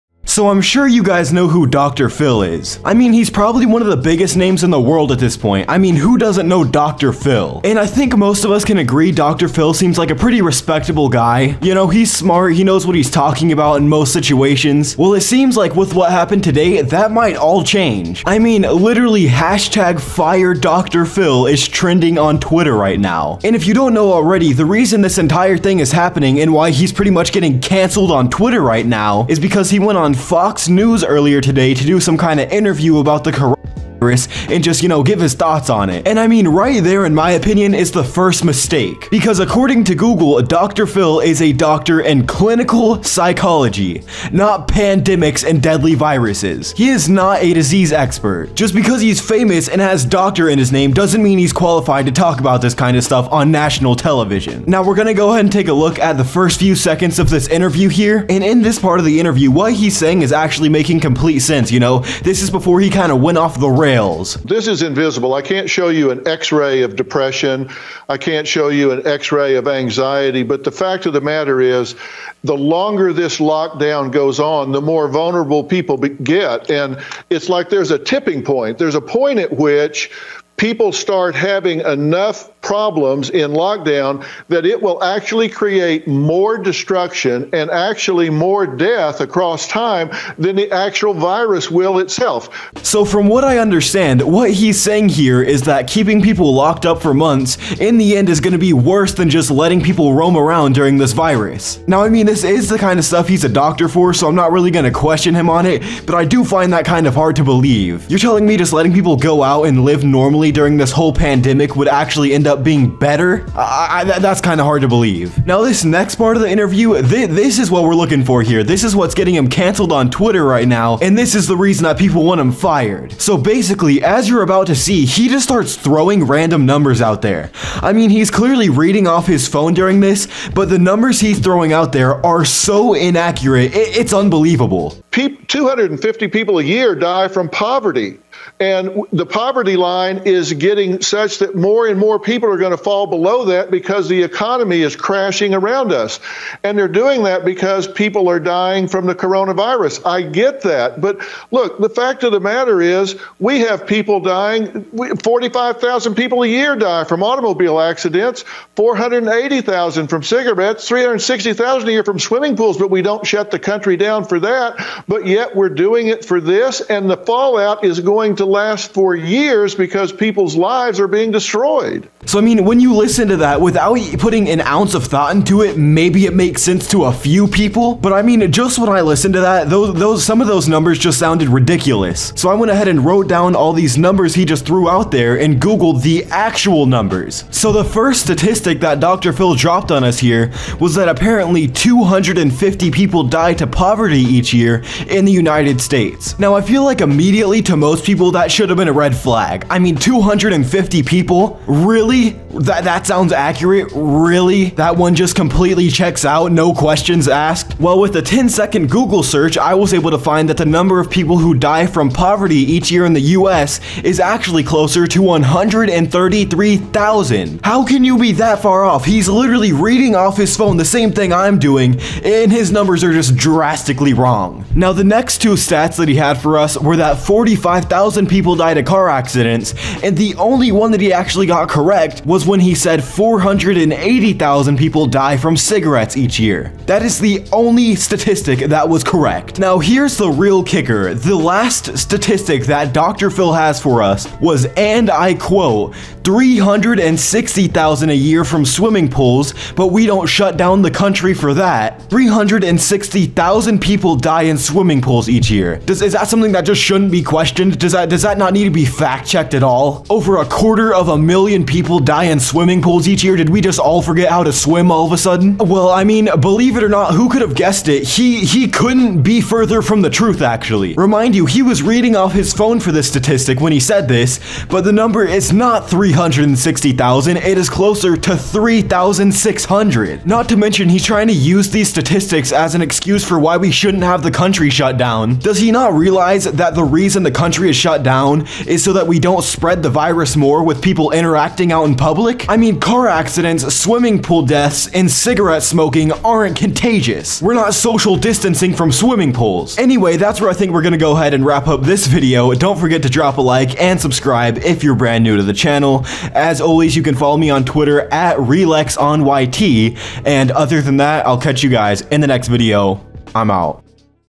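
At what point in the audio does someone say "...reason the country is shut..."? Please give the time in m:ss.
4:46.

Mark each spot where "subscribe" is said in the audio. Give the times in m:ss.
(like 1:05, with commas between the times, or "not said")
5:03.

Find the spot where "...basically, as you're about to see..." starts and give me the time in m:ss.
2:03.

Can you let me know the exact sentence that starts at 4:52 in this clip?
I mean, car accidents, swimming pool deaths, and cigarette smoking aren't contagious.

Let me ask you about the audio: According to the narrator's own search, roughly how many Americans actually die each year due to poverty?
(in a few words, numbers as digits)
133,000.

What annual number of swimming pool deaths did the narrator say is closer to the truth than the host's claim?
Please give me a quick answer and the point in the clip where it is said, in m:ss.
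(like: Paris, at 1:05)
3,600, at 4:38.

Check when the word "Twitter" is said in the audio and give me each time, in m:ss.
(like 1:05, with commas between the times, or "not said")
0:22, 0:28, 2:00, 5:07.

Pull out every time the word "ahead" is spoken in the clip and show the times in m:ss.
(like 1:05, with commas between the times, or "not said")
0:55, 3:02, 5:01.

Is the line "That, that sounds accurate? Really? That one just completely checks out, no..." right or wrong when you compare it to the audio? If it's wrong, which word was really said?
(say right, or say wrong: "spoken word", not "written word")
right.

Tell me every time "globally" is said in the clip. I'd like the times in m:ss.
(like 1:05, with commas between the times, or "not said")
not said.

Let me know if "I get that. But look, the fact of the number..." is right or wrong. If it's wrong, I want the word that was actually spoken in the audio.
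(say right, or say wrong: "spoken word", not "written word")
wrong: "matter", not "number".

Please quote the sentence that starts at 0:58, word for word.
And in this part of the interview, what he's saying is actually making complete sense, you know?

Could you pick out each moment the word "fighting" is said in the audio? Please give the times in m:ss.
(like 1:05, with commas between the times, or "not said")
not said.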